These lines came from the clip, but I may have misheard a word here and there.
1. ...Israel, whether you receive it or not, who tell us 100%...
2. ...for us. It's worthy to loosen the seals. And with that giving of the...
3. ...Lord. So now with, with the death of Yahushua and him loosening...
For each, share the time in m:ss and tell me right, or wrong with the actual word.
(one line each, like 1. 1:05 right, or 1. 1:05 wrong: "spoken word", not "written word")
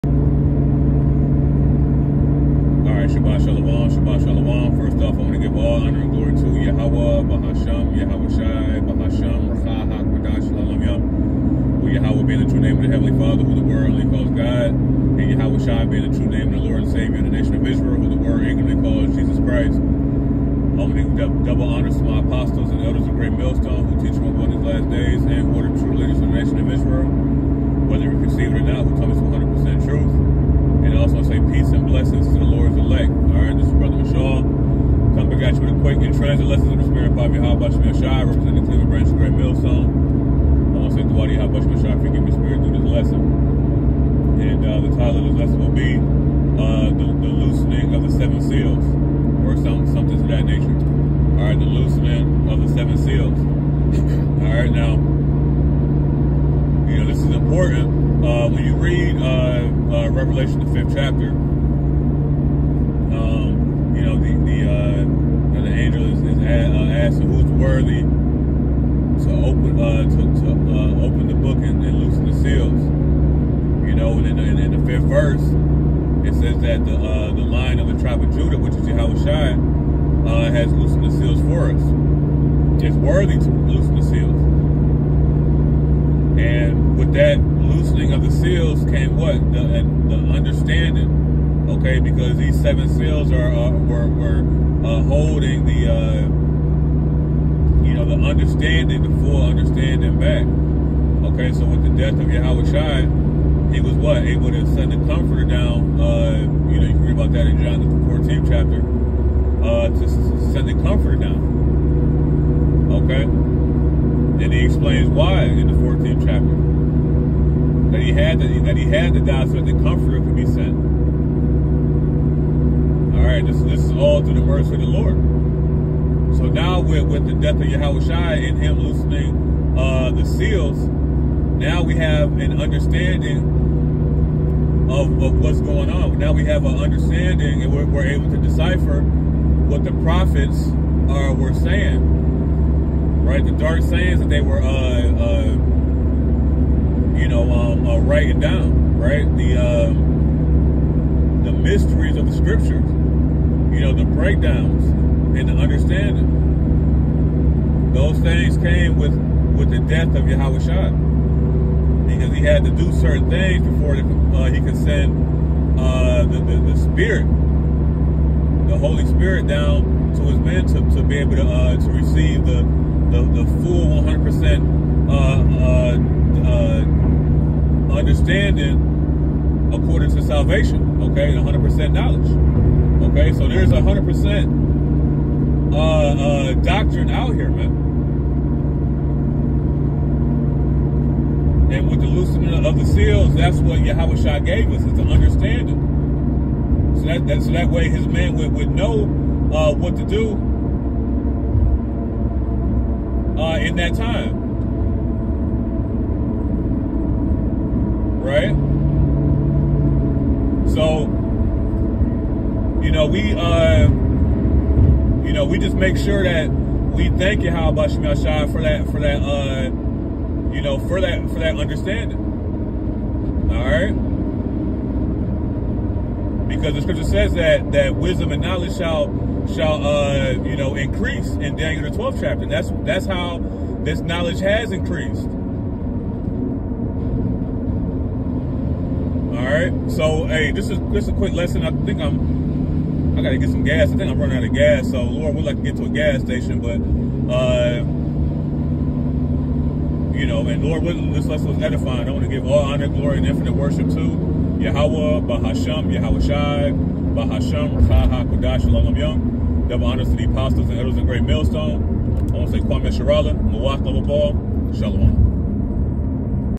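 1. 0:26 right
2. 1:21 wrong: "loosening", not "giving"
3. 2:04 right.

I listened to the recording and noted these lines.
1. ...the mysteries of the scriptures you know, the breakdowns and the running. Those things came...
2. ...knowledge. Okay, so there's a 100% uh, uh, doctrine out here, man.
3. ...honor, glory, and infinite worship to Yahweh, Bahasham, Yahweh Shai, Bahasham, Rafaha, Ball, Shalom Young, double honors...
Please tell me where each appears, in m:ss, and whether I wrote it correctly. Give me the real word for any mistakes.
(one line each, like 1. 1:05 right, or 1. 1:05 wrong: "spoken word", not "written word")
1. 2:31 wrong: "understanding", not "running"
2. 3:01 right
3. 4:12 wrong: "Kodash", not "Ball".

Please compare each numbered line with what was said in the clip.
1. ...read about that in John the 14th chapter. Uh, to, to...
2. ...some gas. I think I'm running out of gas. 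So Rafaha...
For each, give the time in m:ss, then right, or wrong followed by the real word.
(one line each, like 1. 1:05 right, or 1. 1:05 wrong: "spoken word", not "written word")
1. 1:47 right
2. 4:03 wrong: "Lord", not "Rafaha".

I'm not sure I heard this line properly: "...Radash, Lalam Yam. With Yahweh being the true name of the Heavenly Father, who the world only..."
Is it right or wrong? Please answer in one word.
right.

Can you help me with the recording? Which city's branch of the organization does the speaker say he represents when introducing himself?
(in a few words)
Cleveland.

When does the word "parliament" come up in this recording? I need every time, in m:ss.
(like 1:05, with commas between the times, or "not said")
not said.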